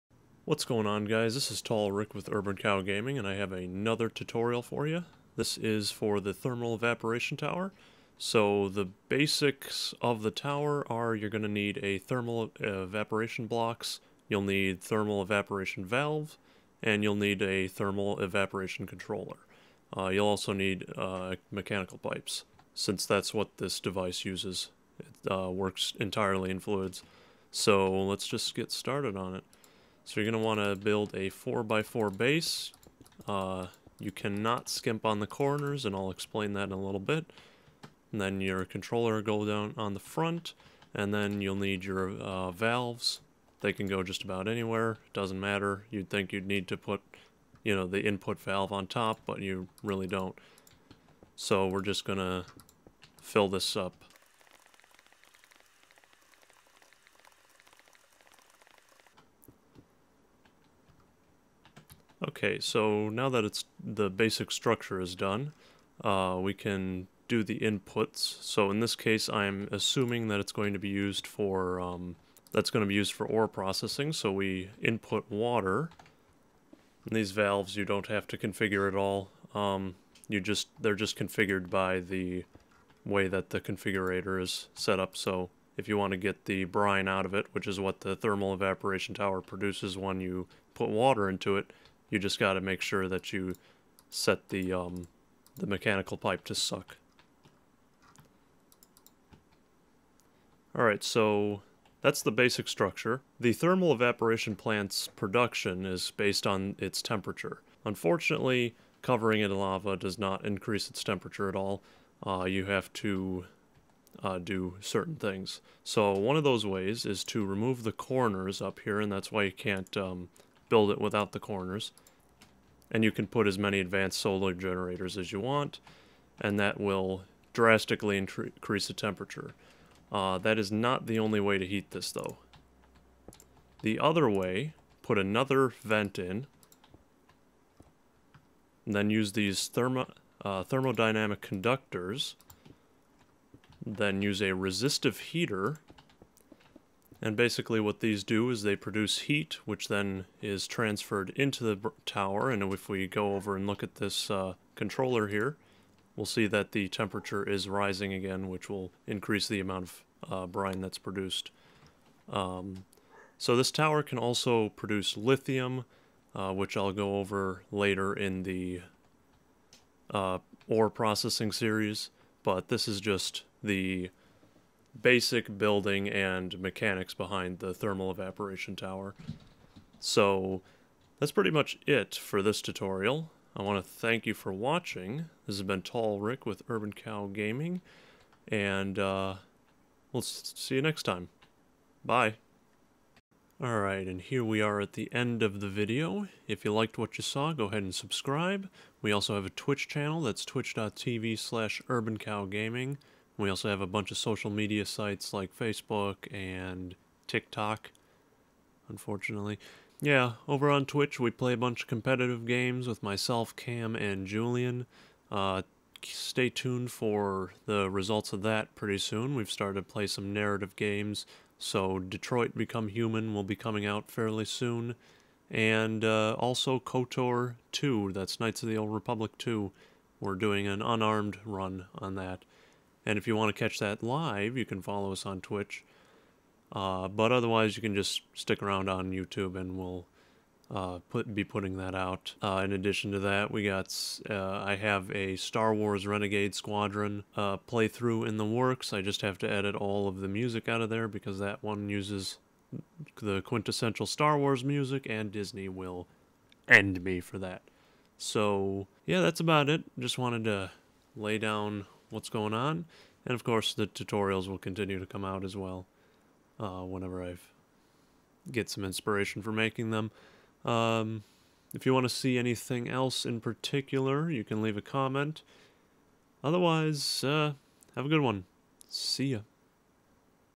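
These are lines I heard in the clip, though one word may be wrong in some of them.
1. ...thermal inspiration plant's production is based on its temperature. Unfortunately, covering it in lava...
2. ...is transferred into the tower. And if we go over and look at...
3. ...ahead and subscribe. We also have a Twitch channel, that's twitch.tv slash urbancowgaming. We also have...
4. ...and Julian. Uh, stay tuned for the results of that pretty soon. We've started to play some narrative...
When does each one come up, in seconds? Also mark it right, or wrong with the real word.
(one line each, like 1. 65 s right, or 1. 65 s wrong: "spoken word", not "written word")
1. 103 s wrong: "evaporation", not "inspiration"
2. 150 s right
3. 197 s right
4. 213 s right.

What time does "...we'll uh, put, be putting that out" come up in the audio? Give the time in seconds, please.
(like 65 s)
239 s.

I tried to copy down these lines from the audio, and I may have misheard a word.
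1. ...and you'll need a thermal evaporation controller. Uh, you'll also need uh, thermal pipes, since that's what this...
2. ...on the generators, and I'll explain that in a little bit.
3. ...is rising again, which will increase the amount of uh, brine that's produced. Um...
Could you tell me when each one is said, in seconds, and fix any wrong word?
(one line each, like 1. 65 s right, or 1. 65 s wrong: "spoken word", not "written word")
1. 16 s wrong: "mechanical", not "thermal"
2. 35 s wrong: "corners", not "generators"
3. 157 s right.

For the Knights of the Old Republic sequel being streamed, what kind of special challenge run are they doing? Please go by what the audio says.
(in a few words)
Unarmed run.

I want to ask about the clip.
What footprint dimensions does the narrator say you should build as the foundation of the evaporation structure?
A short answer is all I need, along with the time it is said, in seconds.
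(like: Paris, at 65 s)
4x4, at 31 s.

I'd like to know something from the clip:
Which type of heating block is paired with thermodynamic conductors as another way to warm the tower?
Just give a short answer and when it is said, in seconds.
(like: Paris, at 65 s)
Resistive heater, at 144 s.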